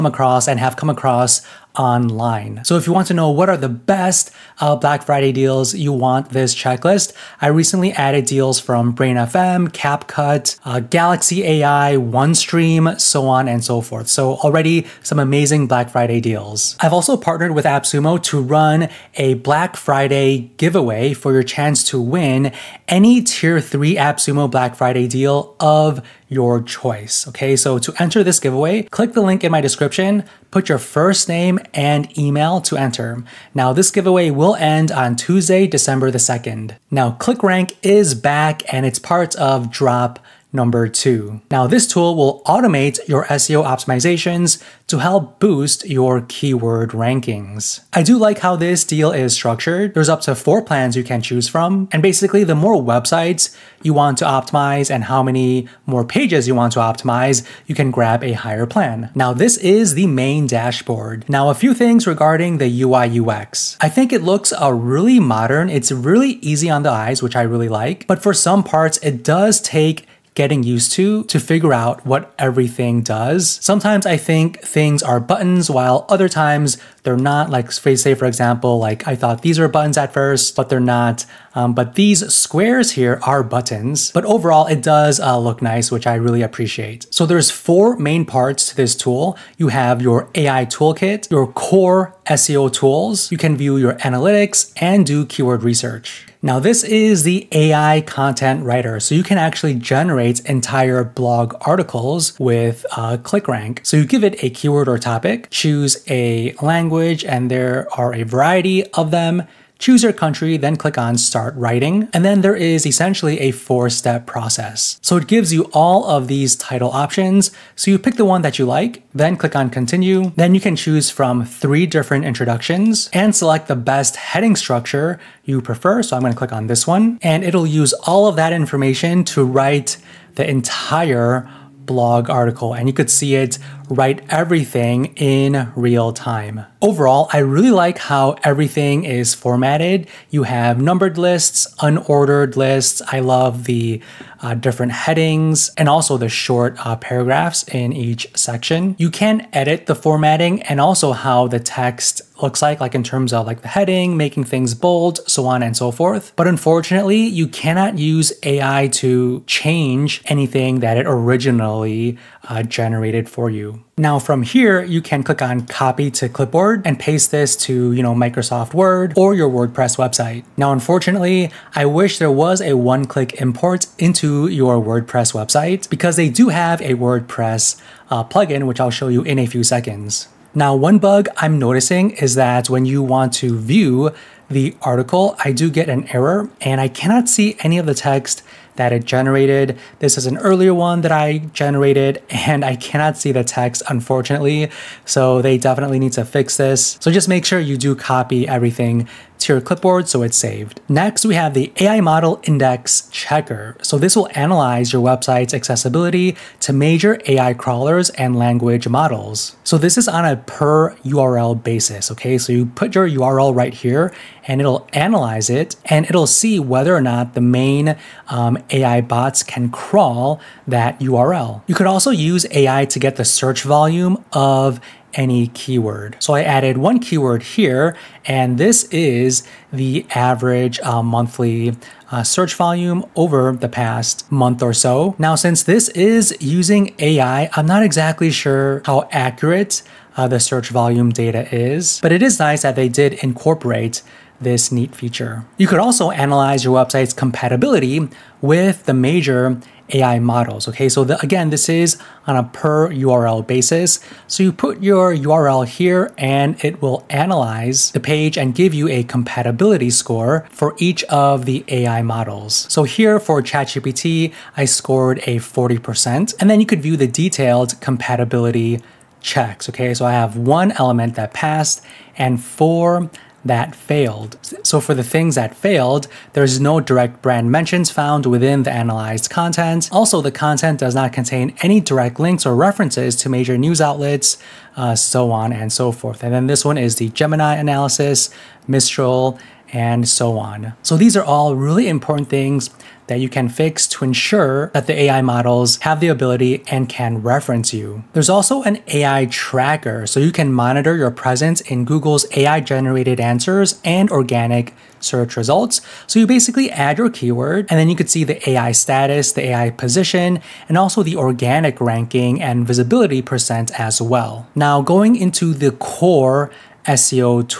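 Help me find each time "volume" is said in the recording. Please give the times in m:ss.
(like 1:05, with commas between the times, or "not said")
3:43, 3:52, 4:00.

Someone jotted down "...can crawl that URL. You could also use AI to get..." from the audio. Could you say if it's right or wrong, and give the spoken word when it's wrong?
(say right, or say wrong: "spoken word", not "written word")
right.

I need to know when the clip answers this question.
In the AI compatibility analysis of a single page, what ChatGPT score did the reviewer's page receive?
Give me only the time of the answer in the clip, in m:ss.
4:25.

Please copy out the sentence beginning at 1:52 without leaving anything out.
And then there is essentially a four step process.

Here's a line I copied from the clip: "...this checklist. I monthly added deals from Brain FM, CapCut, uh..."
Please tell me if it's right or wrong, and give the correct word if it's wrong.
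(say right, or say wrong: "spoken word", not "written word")
wrong: "recently", not "monthly".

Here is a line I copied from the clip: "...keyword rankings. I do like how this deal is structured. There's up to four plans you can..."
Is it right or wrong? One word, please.
right.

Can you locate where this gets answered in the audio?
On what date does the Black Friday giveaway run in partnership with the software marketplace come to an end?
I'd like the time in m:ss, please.
0:35.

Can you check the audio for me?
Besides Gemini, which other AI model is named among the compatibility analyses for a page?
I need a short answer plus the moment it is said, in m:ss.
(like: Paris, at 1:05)
Mistral, at 4:48.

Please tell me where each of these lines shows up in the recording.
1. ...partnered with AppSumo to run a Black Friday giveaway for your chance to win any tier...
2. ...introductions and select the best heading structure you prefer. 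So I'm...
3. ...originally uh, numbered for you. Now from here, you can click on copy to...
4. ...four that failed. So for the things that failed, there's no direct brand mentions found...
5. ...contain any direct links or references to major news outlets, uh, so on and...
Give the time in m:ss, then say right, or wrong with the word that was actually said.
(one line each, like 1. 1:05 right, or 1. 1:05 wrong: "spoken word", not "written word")
1. 0:17 right
2. 2:02 right
3. 2:41 wrong: "generated", not "numbered"
4. 4:32 right
5. 4:41 right.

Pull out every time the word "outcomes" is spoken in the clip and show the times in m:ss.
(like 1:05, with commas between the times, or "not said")
not said.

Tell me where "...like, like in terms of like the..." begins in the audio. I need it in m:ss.
2:32.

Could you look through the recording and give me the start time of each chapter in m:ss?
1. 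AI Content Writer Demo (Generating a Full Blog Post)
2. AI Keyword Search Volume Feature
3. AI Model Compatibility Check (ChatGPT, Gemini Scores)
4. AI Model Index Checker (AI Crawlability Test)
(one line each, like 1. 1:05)
1. 1:47
2. 4:00
3. 4:16
4. 3:40.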